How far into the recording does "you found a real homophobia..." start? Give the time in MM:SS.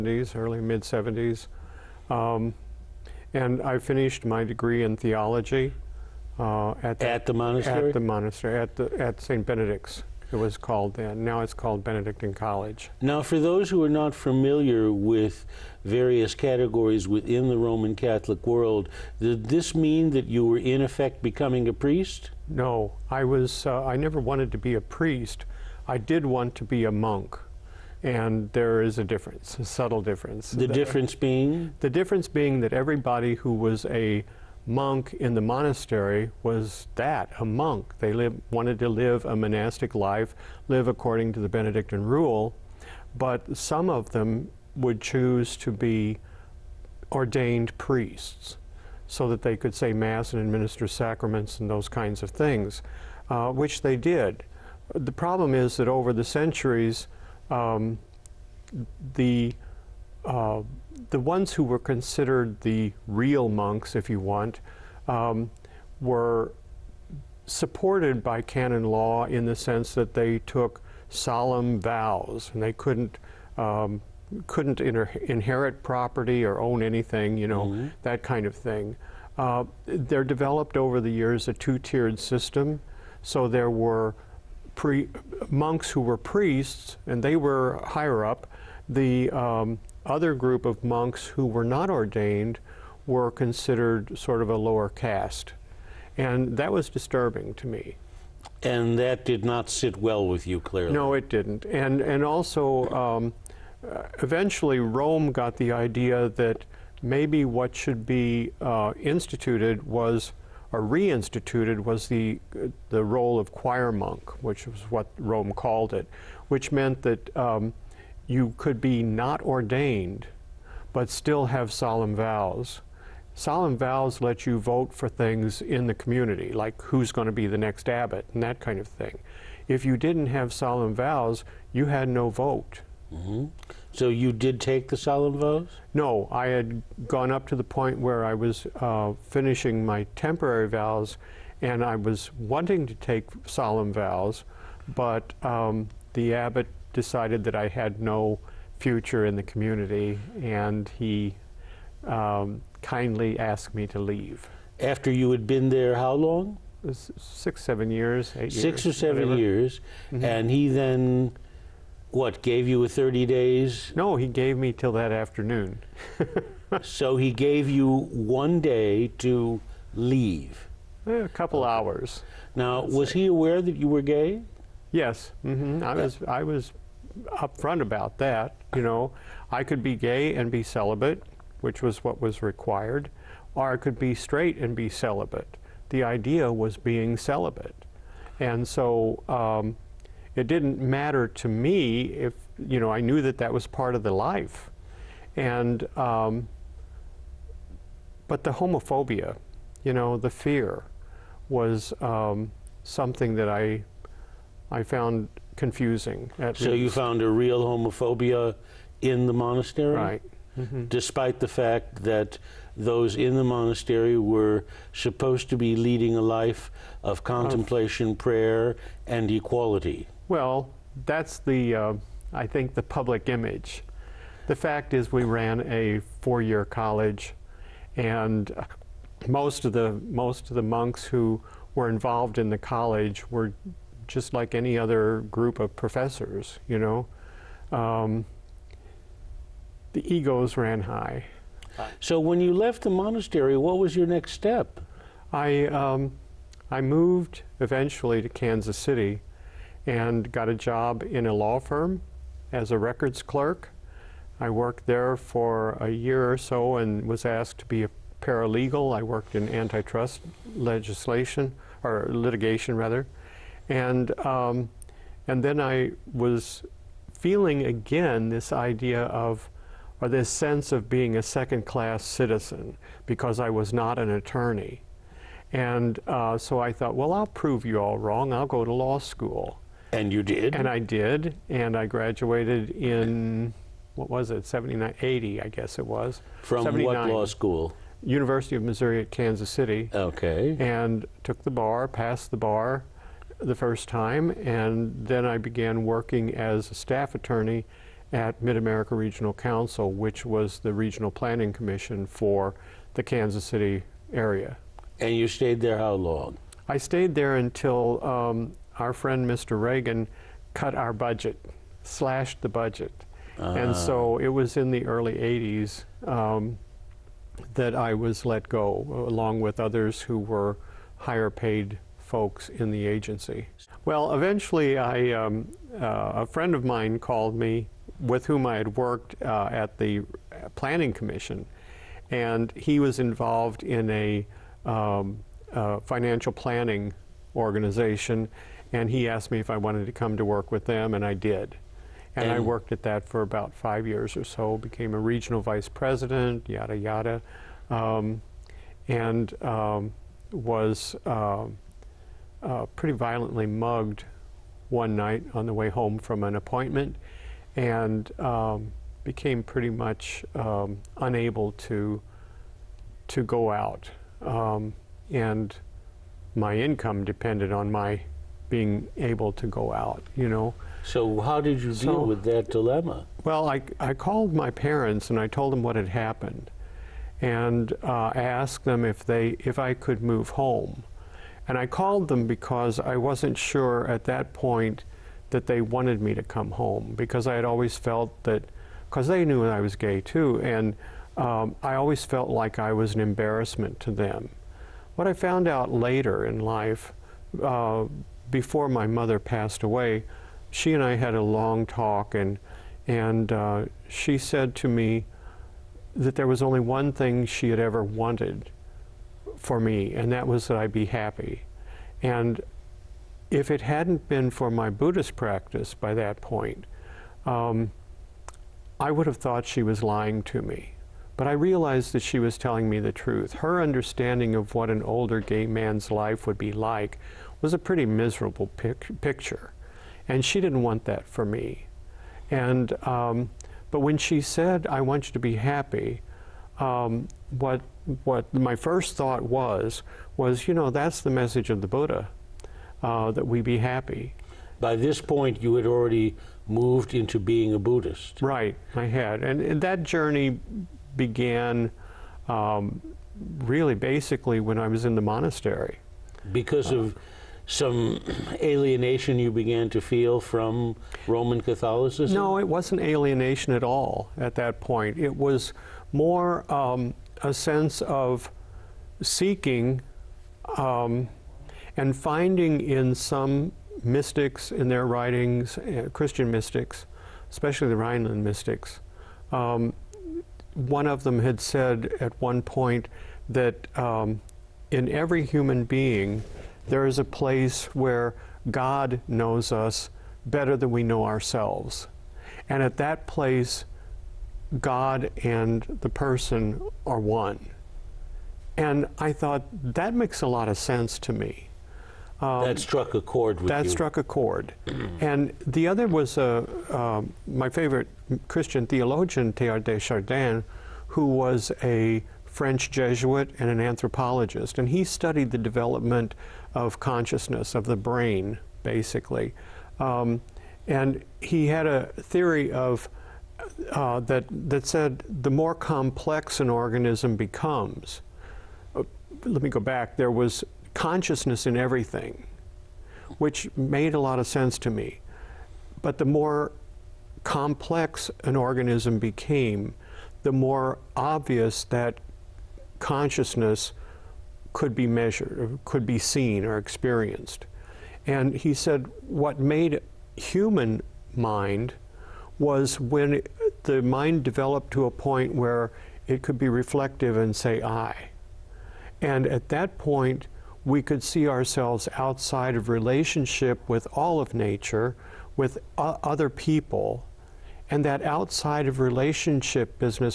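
03:26.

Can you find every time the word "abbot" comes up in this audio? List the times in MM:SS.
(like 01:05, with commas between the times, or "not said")
02:07, 02:26.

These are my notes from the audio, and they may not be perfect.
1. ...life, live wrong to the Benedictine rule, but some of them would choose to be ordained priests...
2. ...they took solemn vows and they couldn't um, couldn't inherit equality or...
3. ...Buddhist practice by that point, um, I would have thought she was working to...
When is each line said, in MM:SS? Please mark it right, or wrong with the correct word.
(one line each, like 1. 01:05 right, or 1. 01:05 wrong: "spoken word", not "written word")
1. 00:39 wrong: "according", not "wrong"
2. 01:10 wrong: "property", not "equality"
3. 06:54 wrong: "lying", not "working".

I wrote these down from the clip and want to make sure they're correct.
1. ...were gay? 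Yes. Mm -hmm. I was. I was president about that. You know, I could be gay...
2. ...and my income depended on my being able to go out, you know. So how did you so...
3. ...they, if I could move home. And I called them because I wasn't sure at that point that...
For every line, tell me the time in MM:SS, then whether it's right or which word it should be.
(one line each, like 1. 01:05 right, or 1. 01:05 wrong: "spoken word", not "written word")
1. 02:53 wrong: "upfront", not "president"
2. 06:05 right
3. 06:19 right.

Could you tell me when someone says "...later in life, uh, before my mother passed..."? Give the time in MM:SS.
06:35.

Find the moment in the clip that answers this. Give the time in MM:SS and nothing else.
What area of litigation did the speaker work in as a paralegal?
04:19.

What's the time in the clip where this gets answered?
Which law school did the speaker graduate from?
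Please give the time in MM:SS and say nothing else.
04:48.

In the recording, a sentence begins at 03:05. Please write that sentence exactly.
The idea was being celibate, and so.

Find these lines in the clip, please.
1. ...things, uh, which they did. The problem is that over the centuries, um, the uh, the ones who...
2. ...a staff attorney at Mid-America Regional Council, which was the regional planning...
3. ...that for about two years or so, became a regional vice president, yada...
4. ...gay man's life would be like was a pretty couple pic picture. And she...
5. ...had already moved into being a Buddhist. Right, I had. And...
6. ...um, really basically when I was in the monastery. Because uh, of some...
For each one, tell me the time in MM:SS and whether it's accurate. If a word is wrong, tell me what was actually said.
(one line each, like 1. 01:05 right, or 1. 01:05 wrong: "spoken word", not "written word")
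1. 00:52 right
2. 04:56 right
3. 05:42 wrong: "five", not "two"
4. 07:05 wrong: "miserable", not "couple"
5. 07:25 right
6. 07:32 right.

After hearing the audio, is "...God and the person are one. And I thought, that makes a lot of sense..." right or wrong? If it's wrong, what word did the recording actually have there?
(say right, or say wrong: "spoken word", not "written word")
right.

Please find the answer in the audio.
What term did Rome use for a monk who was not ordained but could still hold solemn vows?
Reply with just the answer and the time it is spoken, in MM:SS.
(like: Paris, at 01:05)
choir monk, at 01:53.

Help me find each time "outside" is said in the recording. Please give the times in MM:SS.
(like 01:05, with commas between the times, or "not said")
09:21, 09:28.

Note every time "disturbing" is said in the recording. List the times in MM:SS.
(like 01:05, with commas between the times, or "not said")
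01:36.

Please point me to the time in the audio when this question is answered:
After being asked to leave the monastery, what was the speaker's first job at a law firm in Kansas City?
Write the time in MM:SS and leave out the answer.
04:12.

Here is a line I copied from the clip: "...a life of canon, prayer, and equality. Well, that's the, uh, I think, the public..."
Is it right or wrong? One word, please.
wrong.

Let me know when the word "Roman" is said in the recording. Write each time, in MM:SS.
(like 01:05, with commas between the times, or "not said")
00:17, 07:41.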